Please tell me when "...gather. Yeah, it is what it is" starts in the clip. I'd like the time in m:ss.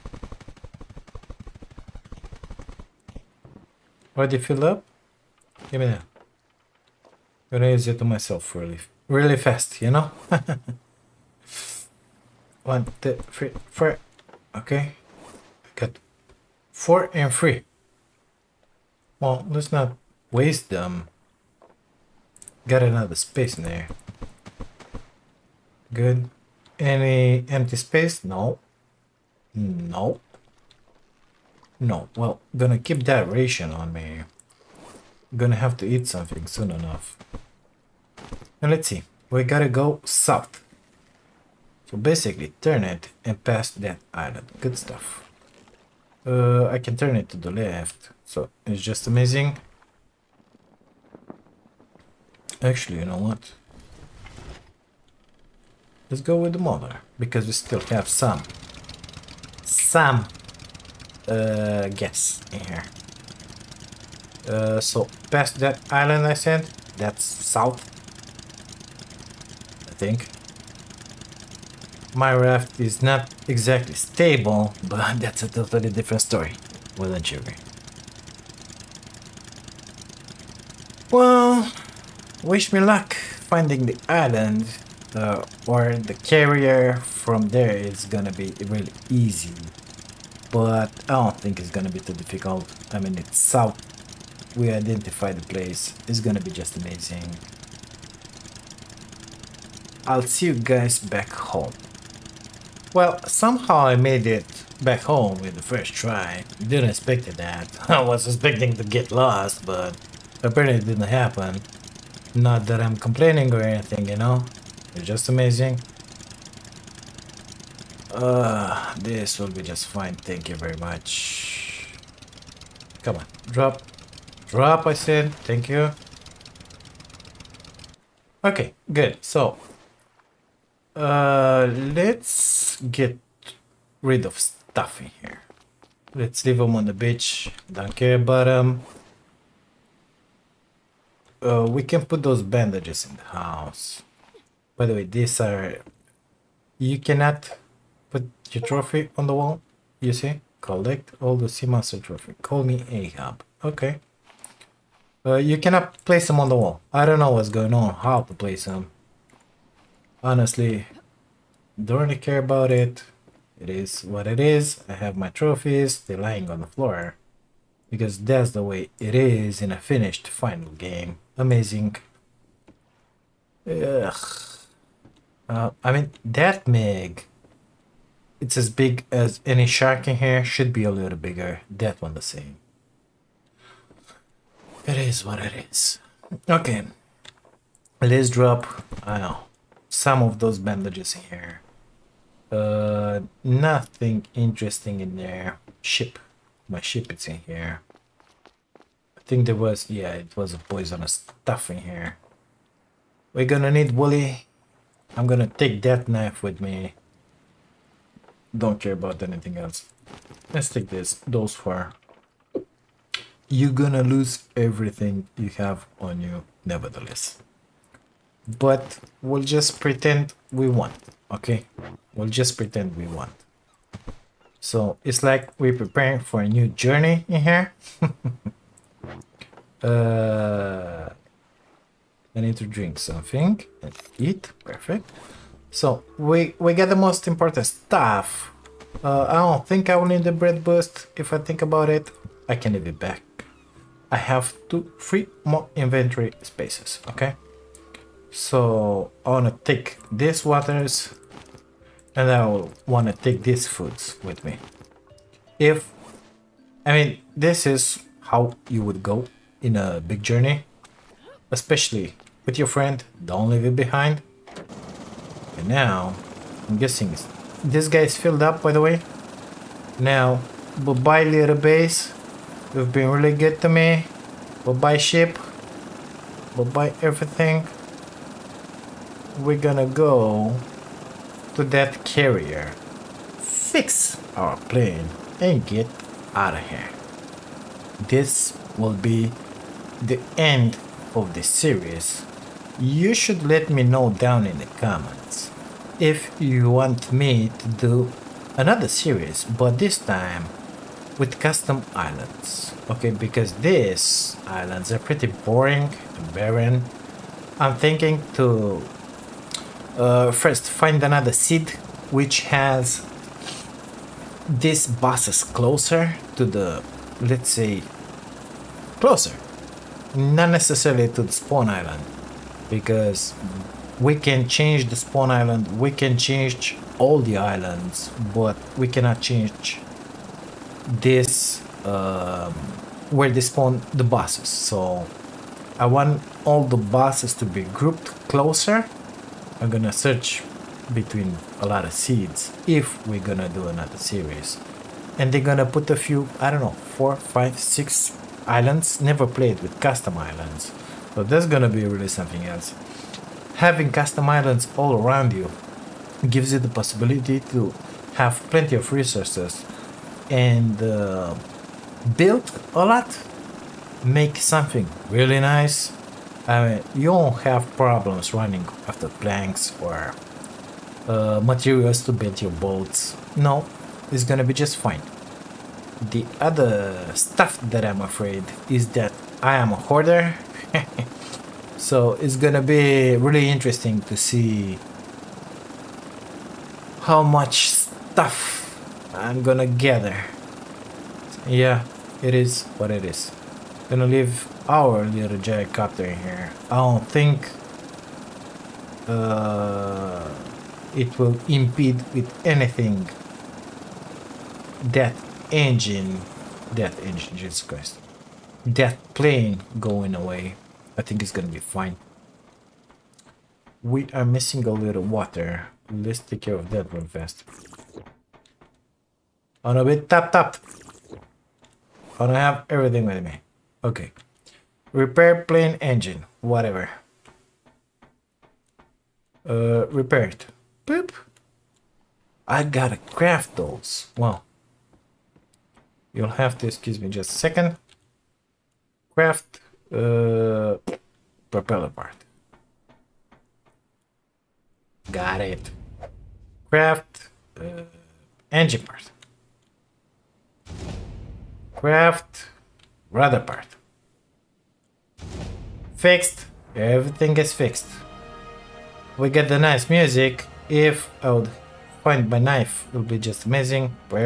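6:29.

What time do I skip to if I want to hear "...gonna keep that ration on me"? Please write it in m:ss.
0:32.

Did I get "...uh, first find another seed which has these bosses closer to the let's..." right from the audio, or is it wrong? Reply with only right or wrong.
right.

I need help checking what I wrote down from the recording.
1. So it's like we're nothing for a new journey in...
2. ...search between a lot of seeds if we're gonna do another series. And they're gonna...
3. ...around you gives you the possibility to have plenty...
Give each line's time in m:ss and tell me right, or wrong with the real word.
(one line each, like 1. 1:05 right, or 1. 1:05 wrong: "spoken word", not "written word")
1. 3:44 wrong: "preparing", not "nothing"
2. 5:39 right
3. 5:54 right.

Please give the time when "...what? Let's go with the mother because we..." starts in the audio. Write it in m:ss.
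0:53.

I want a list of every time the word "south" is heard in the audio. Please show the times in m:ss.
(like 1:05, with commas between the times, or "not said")
0:40, 1:07, 1:33.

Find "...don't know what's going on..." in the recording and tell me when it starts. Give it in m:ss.
2:37.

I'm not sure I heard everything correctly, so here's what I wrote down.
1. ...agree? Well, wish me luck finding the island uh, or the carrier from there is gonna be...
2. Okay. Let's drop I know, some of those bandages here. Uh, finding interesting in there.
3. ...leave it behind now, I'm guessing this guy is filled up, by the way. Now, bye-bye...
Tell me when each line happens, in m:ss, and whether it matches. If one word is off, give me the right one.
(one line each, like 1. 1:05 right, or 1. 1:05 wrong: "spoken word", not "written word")
1. 1:17 right
2. 3:06 wrong: "nothing", not "finding"
3. 4:23 right.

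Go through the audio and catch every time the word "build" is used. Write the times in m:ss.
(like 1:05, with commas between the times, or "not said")
6:02, 6:12.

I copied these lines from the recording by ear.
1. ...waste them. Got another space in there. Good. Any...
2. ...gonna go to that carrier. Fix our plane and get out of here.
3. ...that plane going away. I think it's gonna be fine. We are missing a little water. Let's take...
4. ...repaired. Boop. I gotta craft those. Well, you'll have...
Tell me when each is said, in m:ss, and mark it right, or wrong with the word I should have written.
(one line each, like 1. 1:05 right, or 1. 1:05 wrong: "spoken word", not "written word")
1. 0:20 right
2. 4:39 right
3. 6:48 right
4. 7:09 right.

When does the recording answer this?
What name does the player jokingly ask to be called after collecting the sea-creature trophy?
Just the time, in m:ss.
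2:32.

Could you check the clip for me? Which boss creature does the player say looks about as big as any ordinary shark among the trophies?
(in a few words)
Meg.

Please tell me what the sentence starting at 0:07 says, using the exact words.
gonna use it to myself really, really fast, you know?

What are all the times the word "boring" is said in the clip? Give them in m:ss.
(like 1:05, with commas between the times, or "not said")
5:05.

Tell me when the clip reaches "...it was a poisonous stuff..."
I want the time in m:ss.
3:20.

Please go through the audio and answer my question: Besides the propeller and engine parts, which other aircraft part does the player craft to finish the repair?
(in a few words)
Rudder part.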